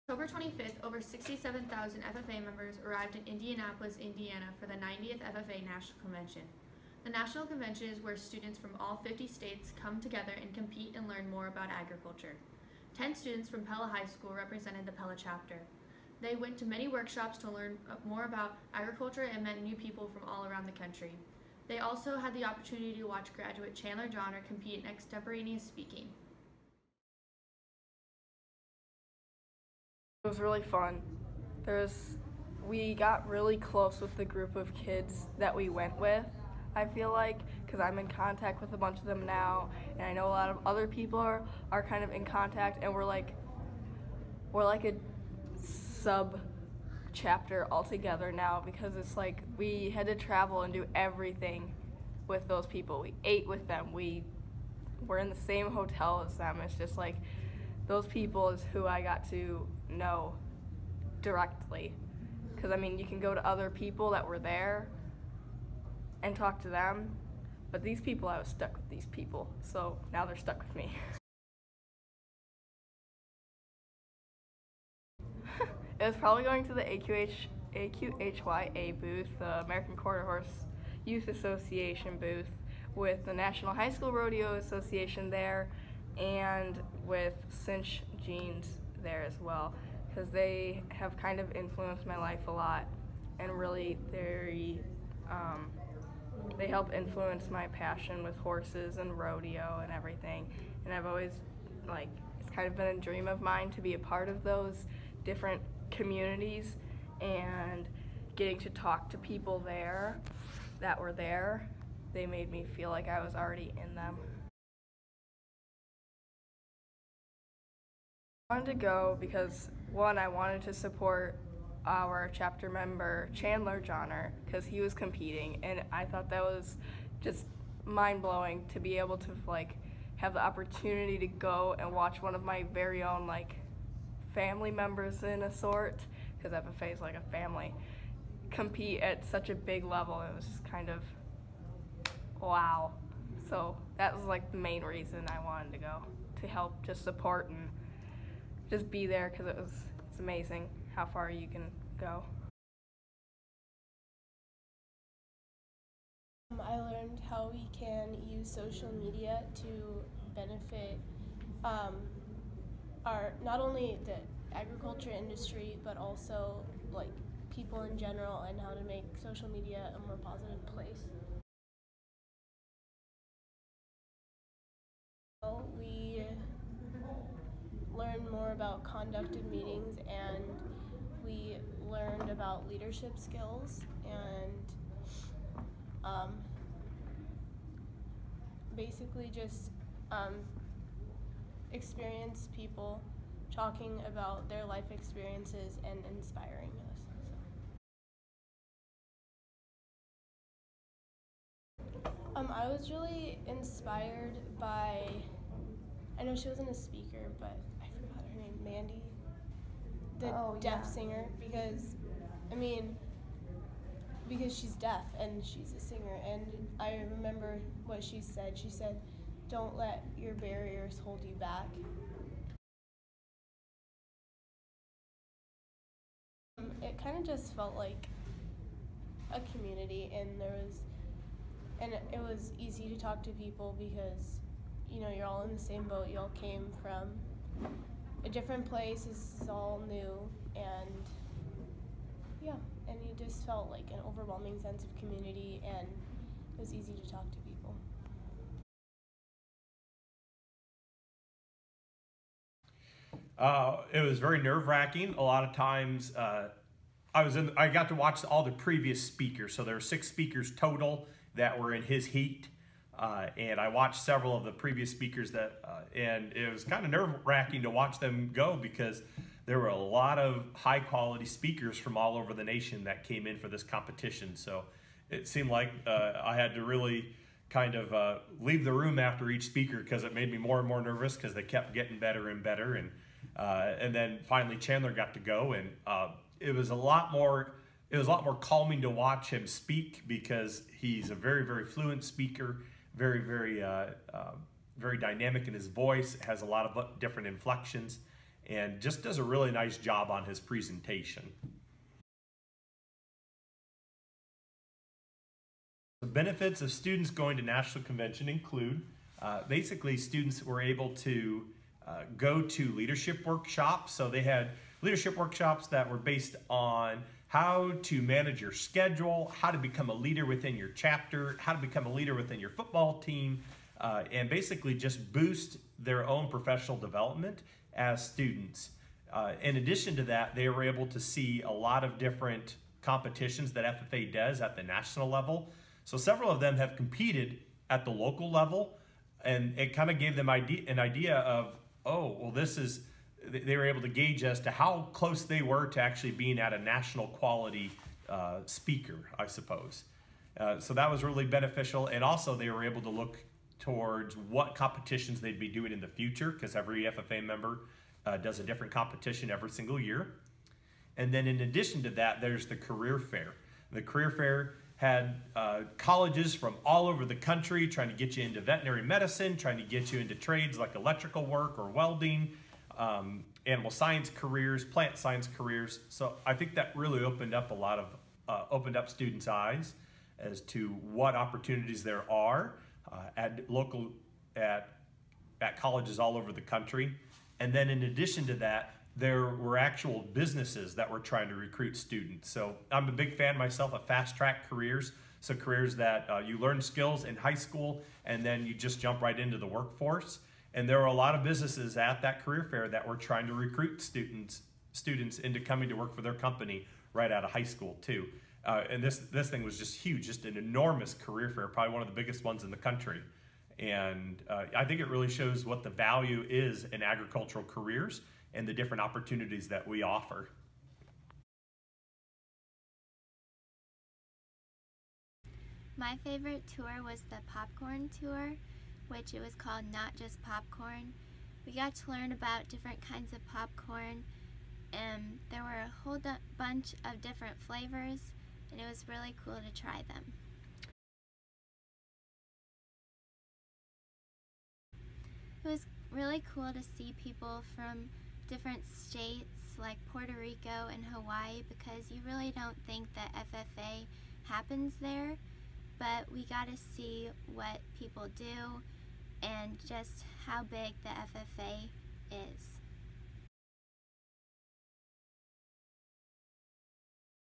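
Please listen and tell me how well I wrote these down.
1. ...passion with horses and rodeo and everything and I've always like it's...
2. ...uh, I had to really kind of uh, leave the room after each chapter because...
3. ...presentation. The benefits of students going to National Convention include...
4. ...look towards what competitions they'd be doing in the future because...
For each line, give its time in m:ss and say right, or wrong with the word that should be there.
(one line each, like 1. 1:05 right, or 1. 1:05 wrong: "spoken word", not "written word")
1. 1:37 right
2. 4:35 wrong: "speaker", not "chapter"
3. 5:00 right
4. 5:52 right.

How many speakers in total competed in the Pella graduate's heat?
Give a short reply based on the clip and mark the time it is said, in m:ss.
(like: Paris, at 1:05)
six, at 4:19.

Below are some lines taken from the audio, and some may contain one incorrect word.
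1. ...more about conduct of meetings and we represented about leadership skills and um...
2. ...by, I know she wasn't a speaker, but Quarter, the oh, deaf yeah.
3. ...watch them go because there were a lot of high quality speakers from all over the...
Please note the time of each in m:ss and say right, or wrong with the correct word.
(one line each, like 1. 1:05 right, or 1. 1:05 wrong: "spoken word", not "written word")
1. 2:58 wrong: "learned", not "represented"
2. 3:24 wrong: "Mandy", not "Quarter"
3. 4:27 right.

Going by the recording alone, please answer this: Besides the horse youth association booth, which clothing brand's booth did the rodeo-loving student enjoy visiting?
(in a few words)
Cinch jeans.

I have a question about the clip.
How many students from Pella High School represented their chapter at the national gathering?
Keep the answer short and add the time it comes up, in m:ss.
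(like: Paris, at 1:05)
10, at 0:12.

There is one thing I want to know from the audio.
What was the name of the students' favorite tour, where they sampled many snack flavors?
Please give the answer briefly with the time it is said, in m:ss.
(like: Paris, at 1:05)
Not Just Popcorn, at 7:09.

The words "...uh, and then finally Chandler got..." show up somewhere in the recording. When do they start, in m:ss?
4:43.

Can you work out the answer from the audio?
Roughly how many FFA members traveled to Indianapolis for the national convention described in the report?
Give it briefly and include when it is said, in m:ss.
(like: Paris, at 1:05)
67,000, at 0:00.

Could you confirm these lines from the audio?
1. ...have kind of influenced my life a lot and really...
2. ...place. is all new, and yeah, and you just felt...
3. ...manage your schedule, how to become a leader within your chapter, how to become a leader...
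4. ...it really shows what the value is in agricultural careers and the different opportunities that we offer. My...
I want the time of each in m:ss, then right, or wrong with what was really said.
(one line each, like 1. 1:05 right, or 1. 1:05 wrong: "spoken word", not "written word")
1. 1:30 right
2. 3:58 right
3. 5:18 right
4. 6:54 right.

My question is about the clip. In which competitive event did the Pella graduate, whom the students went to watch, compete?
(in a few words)
extemporaneous speaking.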